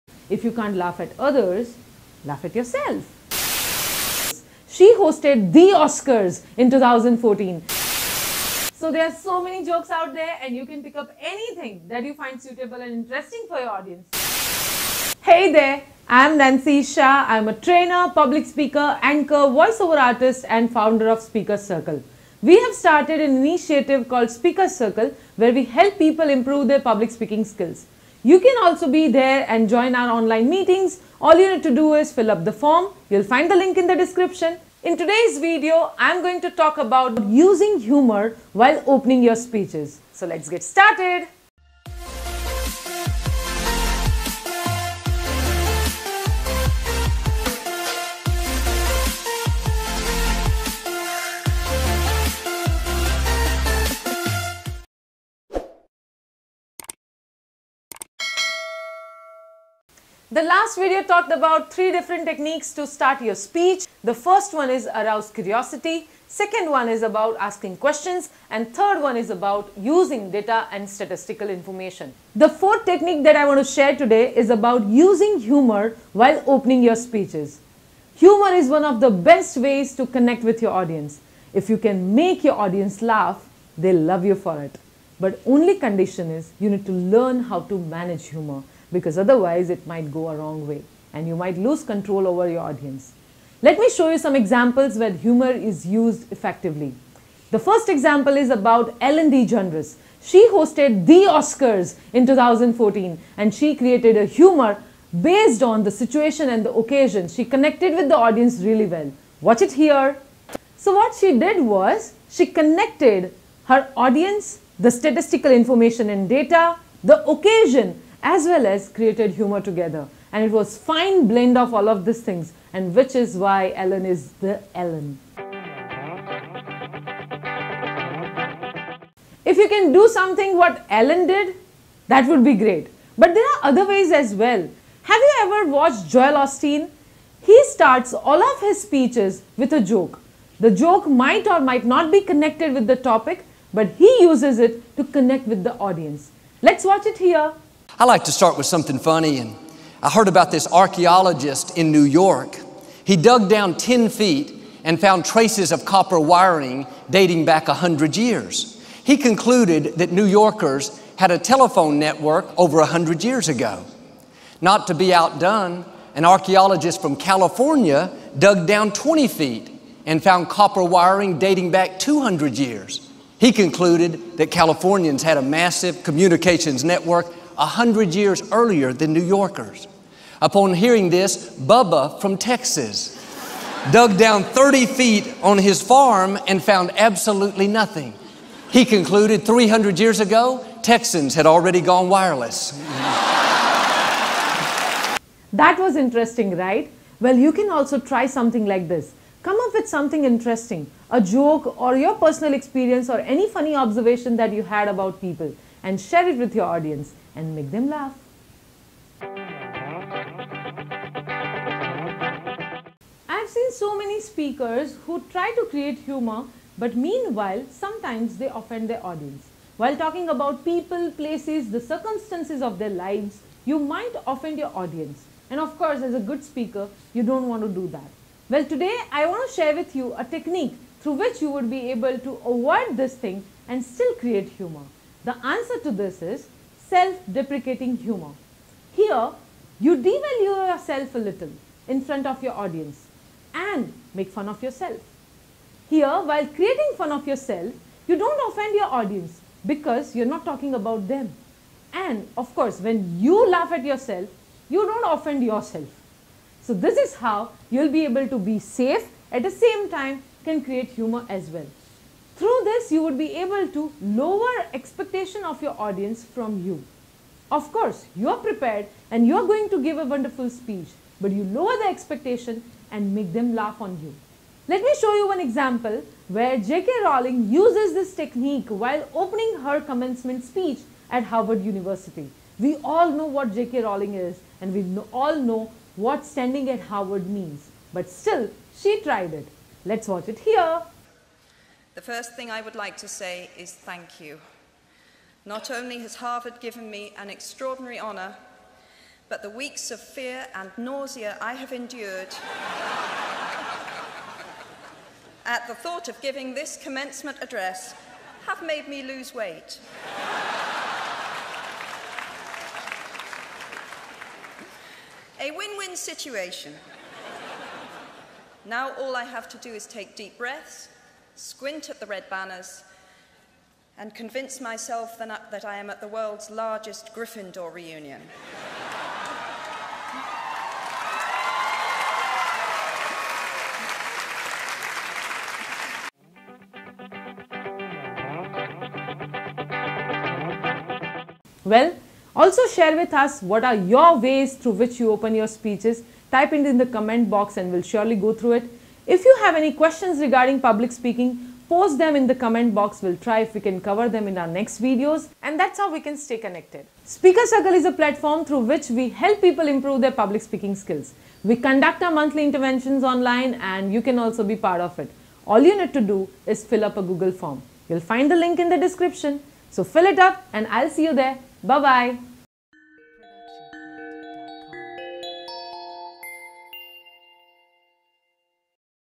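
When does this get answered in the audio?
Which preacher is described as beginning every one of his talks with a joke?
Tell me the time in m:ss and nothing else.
2:16.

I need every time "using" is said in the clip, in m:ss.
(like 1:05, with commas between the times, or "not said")
0:37, 1:09, 1:14.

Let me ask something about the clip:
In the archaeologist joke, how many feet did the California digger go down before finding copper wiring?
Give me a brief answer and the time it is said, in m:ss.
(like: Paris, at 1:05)
20 feet, at 2:48.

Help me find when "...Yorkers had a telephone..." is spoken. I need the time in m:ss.
2:40.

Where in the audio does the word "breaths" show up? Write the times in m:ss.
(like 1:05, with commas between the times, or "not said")
5:20.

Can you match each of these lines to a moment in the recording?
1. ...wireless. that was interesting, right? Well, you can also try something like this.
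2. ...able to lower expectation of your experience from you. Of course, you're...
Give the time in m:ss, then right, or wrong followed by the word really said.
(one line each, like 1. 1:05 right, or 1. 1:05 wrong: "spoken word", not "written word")
1. 3:12 right
2. 4:23 wrong: "audience", not "experience".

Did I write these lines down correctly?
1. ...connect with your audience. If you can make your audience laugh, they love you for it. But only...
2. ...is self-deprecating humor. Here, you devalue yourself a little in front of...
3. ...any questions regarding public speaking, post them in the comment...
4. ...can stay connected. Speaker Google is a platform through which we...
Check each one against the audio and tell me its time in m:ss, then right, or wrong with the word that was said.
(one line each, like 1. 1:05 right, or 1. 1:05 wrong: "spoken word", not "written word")
1. 1:20 right
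2. 3:56 right
3. 5:49 right
4. 5:55 wrong: "Circle", not "Google".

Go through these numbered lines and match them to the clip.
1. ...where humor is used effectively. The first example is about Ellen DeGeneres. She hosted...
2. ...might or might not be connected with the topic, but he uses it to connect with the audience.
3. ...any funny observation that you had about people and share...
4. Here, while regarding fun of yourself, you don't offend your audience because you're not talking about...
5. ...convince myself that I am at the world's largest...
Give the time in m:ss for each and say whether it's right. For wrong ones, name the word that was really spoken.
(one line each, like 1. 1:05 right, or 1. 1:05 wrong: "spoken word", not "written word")
1. 1:34 right
2. 2:21 right
3. 3:23 right
4. 4:05 wrong: "creating", not "regarding"
5. 5:24 right.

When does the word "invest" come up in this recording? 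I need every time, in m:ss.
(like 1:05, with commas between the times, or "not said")
not said.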